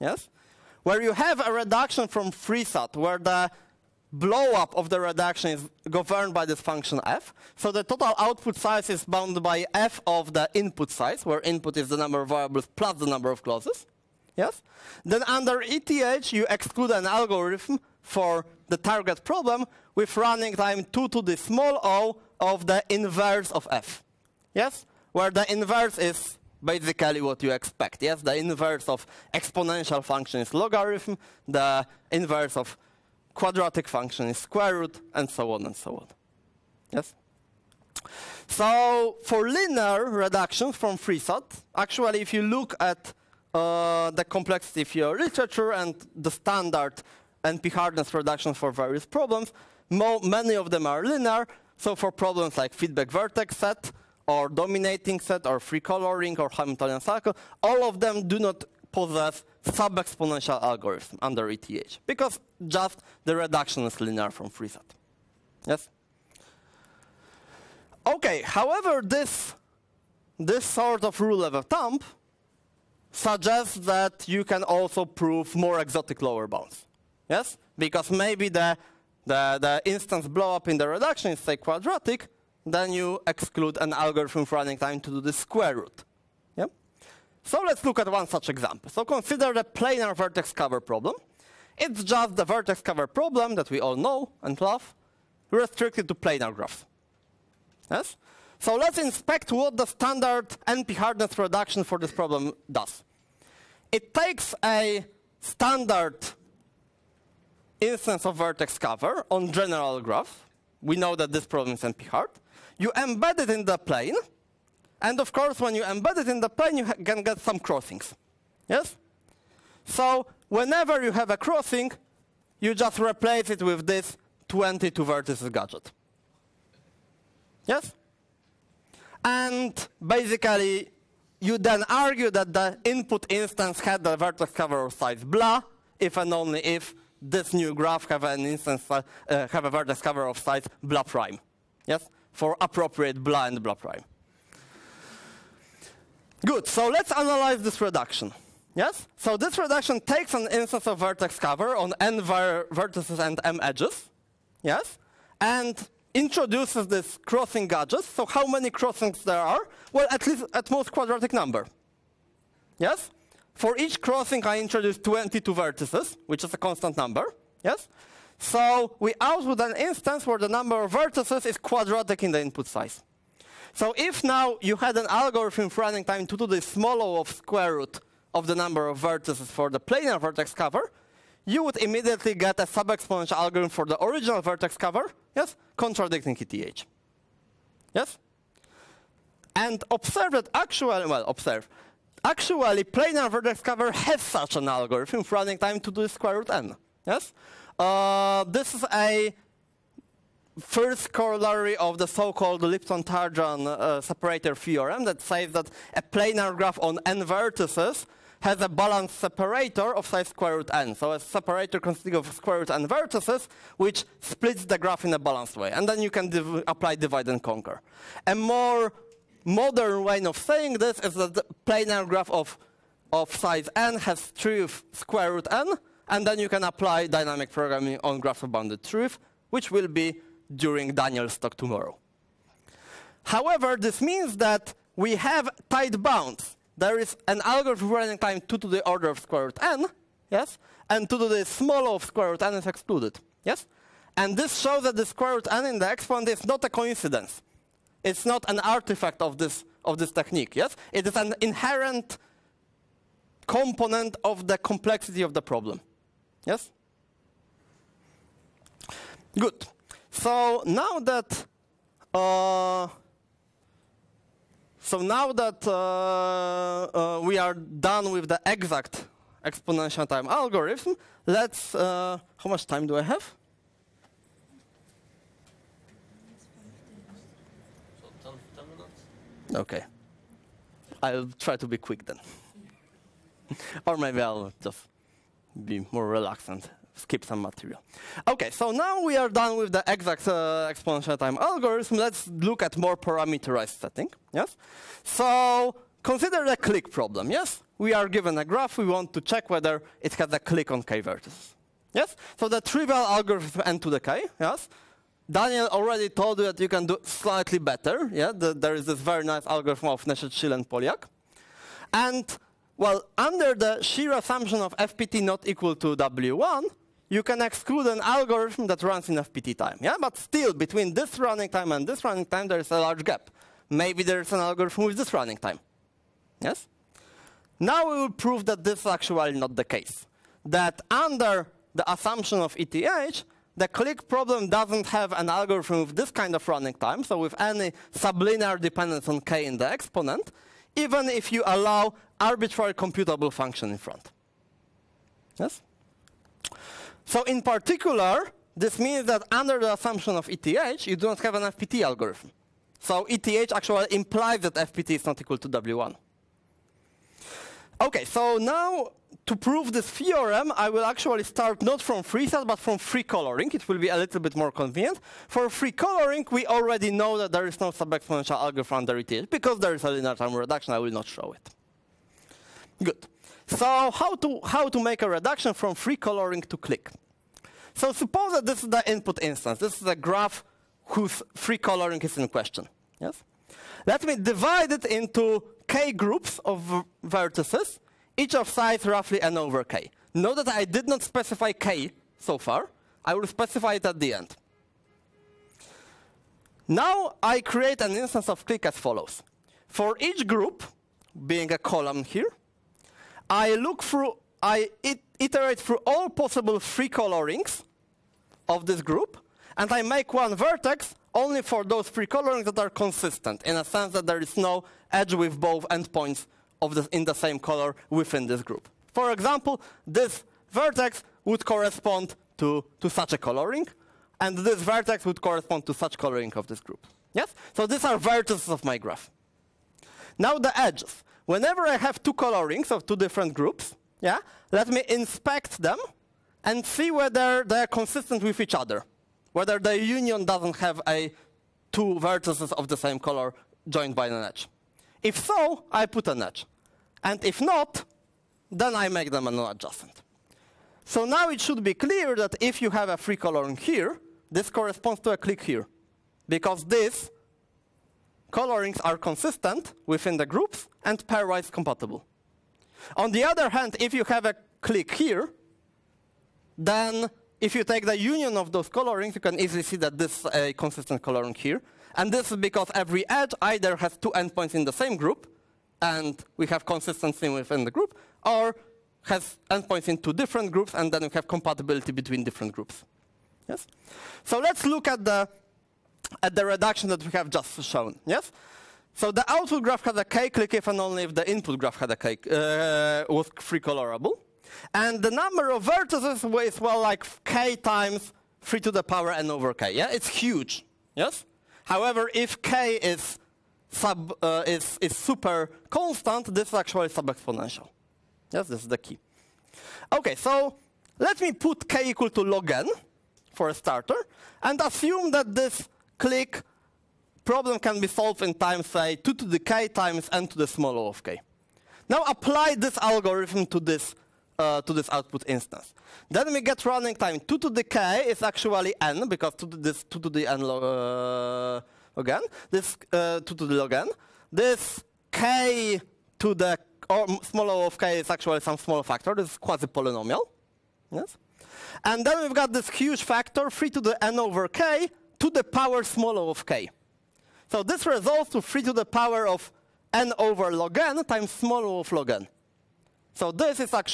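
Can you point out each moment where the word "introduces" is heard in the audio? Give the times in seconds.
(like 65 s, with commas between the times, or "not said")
156 s, 164 s.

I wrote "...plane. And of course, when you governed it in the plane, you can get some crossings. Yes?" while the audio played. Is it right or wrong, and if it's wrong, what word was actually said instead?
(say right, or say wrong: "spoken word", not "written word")
wrong: "embed", not "governed".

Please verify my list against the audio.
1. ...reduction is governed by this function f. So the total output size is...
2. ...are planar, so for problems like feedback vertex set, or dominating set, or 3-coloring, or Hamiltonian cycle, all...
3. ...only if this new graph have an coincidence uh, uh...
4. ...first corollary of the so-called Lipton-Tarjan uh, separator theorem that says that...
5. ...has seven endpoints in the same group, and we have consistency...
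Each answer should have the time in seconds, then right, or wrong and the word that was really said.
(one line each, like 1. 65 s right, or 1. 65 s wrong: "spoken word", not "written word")
1. 4 s right
2. 50 s wrong: "linear", not "planar"
3. 136 s wrong: "instance", not "coincidence"
4. 200 s right
5. 473 s wrong: "two", not "seven".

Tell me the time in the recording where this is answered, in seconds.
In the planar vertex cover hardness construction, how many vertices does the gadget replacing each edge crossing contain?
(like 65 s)
124 s.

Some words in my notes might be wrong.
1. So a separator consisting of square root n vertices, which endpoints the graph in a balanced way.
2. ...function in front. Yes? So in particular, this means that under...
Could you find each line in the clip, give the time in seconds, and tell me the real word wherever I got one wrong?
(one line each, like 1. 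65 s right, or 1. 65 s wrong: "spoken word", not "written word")
1. 210 s wrong: "splits", not "endpoints"
2. 343 s right.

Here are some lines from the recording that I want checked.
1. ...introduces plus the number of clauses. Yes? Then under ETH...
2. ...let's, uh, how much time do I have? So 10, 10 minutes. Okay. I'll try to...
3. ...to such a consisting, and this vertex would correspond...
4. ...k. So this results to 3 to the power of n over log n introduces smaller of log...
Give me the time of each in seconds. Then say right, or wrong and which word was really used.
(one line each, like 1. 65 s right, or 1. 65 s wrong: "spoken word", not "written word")
1. 12 s wrong: "variables", not "introduces"
2. 271 s right
3. 422 s wrong: "coloring", not "consisting"
4. 546 s wrong: "times", not "introduces".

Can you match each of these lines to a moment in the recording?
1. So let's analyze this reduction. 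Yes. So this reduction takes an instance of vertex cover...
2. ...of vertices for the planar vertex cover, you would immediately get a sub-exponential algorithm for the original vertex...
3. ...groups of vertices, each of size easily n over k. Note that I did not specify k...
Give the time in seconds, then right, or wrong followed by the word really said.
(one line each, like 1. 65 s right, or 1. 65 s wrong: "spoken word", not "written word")
1. 146 s right
2. 178 s right
3. 385 s wrong: "roughly", not "easily".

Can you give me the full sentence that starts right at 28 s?
Yes, the inverse of exponential function is logarithm, the inverse of quadratic function is square root, and so on and so on.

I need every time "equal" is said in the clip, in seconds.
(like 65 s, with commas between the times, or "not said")
315 s, 355 s, 511 s.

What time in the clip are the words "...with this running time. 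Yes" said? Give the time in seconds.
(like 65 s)
324 s.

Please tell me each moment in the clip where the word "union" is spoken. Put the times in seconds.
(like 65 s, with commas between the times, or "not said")
439 s, 467 s.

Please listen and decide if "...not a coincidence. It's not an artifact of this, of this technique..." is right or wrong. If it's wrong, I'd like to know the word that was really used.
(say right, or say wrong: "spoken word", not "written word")
right.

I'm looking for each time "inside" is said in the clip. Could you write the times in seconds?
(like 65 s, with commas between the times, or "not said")
not said.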